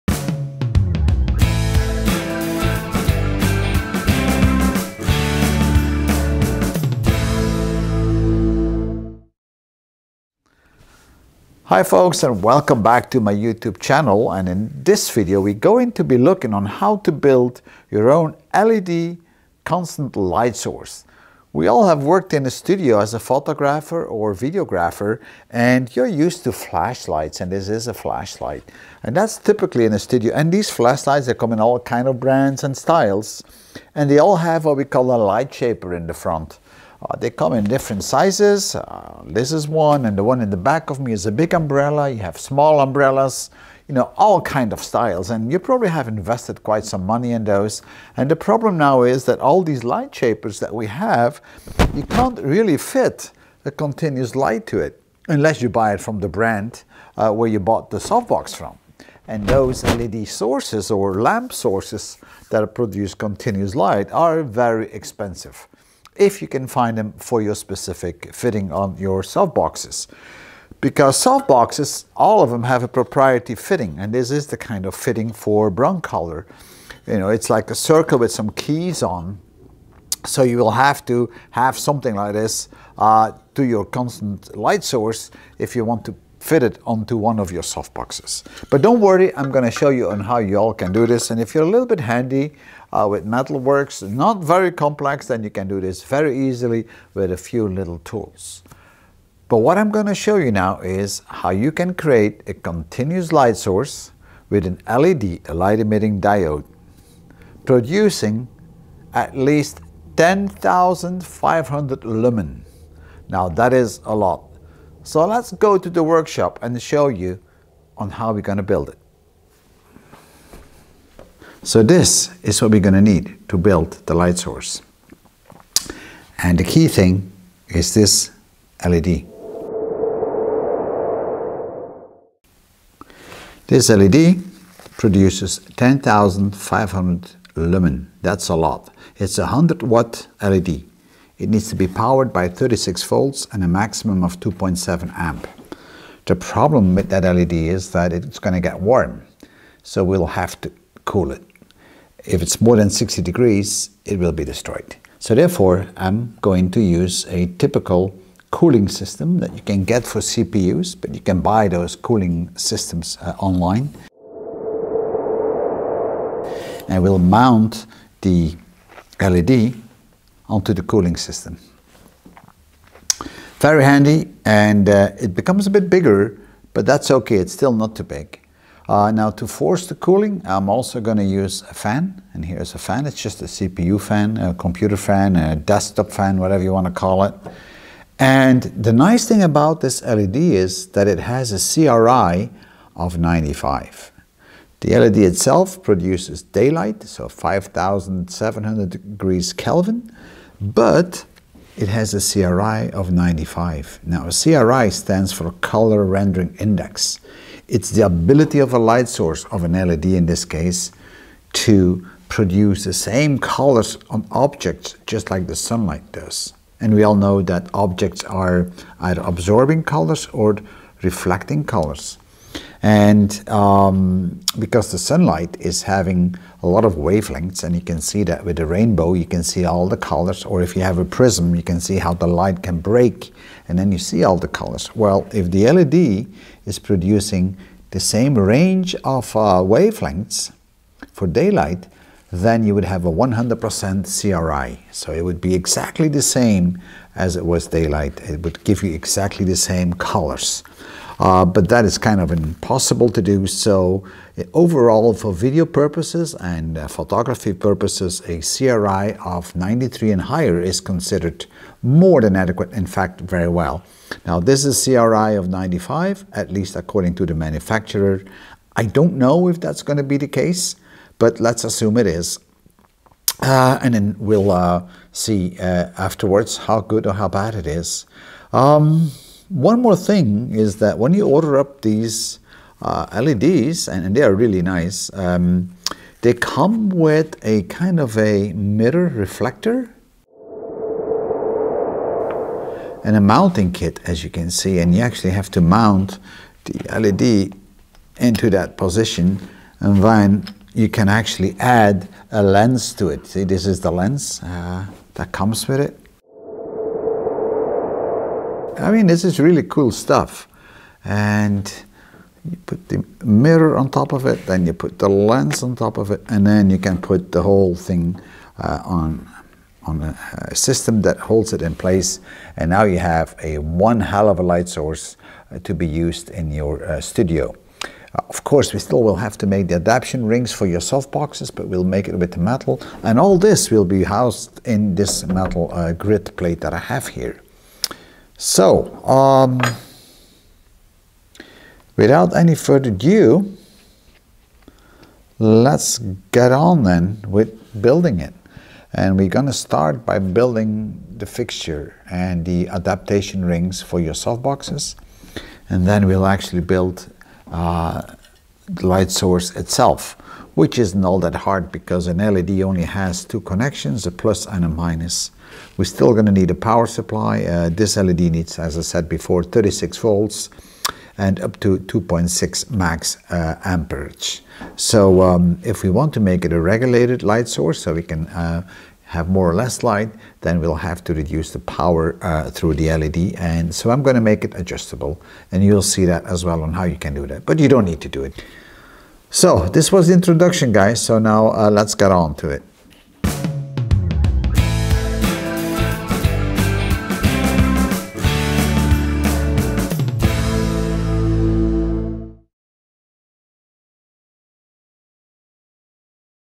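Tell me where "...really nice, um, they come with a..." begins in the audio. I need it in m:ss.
4:44.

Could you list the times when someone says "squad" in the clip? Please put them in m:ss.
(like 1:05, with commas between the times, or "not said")
not said.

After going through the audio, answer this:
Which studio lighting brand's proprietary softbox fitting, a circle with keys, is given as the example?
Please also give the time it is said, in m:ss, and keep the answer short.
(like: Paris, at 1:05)
Broncolor, at 1:15.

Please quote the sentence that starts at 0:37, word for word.
Uh, they come in different sizes.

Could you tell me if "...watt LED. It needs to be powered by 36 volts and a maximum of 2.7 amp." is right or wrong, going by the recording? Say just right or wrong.
right.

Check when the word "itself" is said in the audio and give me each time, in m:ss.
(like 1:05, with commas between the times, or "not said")
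3:15, 5:59.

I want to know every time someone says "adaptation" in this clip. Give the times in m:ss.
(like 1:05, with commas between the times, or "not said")
5:29, 5:52.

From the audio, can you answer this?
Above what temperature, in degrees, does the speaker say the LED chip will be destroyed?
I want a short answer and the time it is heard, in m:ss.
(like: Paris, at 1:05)
60 degrees, at 2:32.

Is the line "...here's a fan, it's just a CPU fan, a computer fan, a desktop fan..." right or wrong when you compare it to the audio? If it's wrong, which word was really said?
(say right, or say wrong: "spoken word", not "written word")
right.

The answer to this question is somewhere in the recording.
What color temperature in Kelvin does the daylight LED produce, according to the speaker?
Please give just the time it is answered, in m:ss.
3:17.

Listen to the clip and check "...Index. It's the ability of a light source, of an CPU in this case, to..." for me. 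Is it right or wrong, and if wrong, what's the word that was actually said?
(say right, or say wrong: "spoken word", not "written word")
wrong: "LED", not "CPU".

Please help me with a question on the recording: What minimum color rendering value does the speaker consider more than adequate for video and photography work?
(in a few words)
93.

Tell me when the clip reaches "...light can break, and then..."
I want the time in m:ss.
3:52.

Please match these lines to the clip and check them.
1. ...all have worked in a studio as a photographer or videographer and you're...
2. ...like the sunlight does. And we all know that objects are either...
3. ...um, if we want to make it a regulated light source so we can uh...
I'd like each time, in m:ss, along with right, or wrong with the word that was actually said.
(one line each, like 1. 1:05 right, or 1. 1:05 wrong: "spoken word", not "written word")
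1. 0:21 right
2. 3:35 right
3. 6:15 right.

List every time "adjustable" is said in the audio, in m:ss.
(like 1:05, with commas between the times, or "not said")
6:24.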